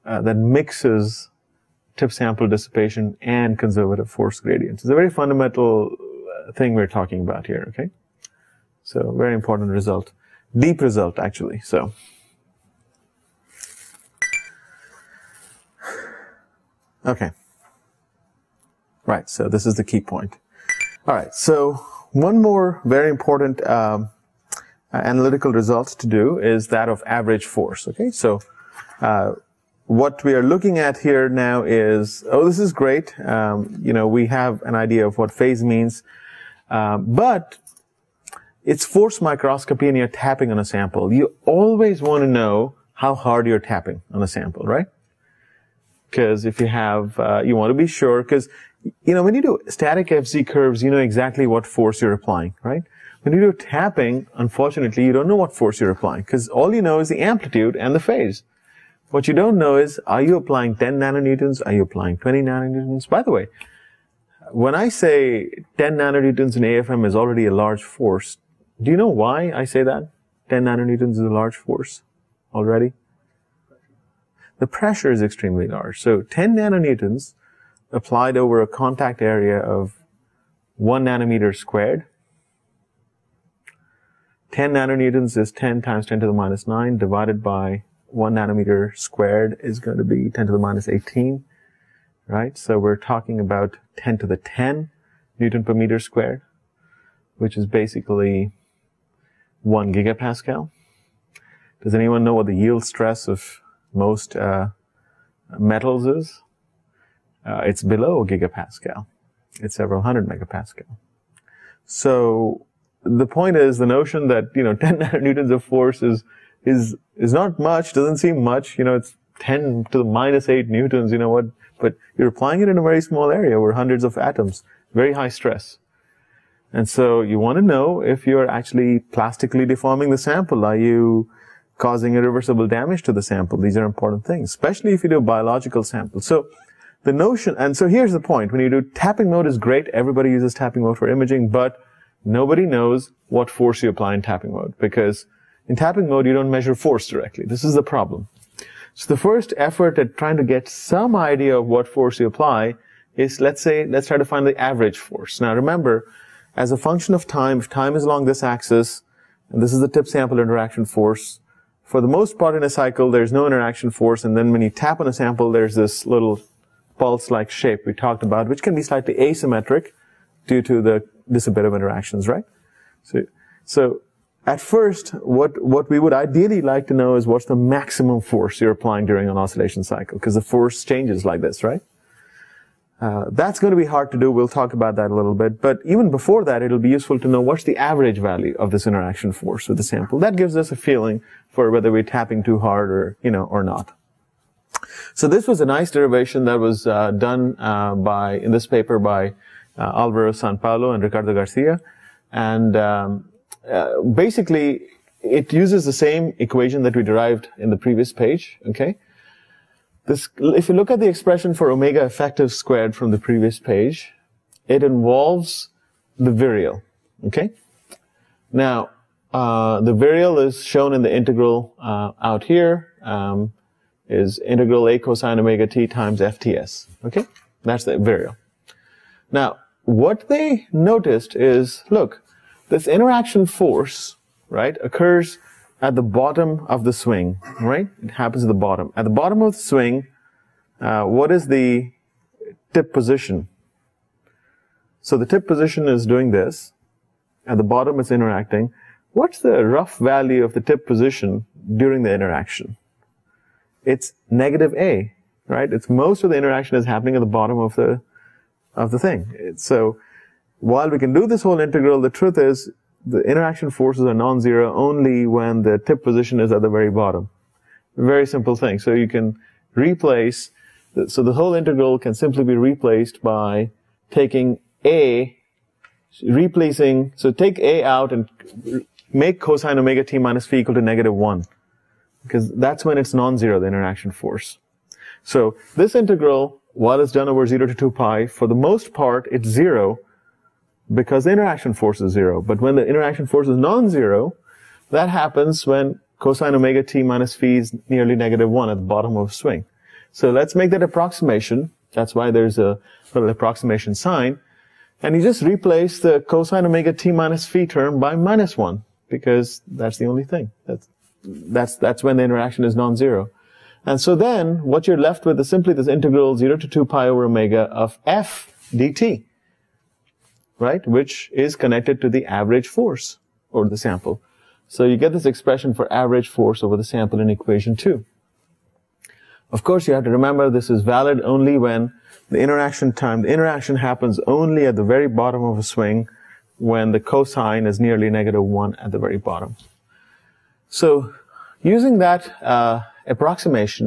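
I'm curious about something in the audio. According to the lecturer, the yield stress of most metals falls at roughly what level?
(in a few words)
several hundred megapascal.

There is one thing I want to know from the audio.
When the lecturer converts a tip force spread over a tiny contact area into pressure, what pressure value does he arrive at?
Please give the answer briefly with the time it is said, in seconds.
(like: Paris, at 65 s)
1 gigapascal, at 99 s.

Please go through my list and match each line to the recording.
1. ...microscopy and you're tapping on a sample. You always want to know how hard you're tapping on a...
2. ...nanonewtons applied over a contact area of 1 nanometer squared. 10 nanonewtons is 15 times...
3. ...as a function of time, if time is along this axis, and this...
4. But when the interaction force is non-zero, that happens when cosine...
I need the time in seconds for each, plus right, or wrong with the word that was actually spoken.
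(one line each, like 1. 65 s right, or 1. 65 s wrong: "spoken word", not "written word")
1. 39 s right
2. 76 s wrong: "10", not "15"
3. 156 s right
4. 292 s right.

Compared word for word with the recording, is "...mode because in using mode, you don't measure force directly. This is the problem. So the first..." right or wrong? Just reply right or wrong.
wrong.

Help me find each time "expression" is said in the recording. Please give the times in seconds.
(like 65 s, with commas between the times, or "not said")
211 s, 325 s.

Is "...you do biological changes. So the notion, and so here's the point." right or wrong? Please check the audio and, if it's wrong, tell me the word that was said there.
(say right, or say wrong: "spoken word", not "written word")
wrong: "samples", not "changes".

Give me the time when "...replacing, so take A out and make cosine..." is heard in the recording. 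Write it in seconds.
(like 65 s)
276 s.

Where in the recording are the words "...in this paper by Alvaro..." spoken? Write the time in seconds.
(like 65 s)
198 s.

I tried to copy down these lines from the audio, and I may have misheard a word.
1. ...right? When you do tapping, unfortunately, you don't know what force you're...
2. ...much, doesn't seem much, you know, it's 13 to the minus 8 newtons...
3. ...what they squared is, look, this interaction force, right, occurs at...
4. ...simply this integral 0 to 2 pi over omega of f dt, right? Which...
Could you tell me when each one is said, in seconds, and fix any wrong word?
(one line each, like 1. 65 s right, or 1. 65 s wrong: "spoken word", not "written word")
1. 52 s right
2. 117 s wrong: "10", not "13"
3. 229 s wrong: "noticed", not "squared"
4. 315 s right.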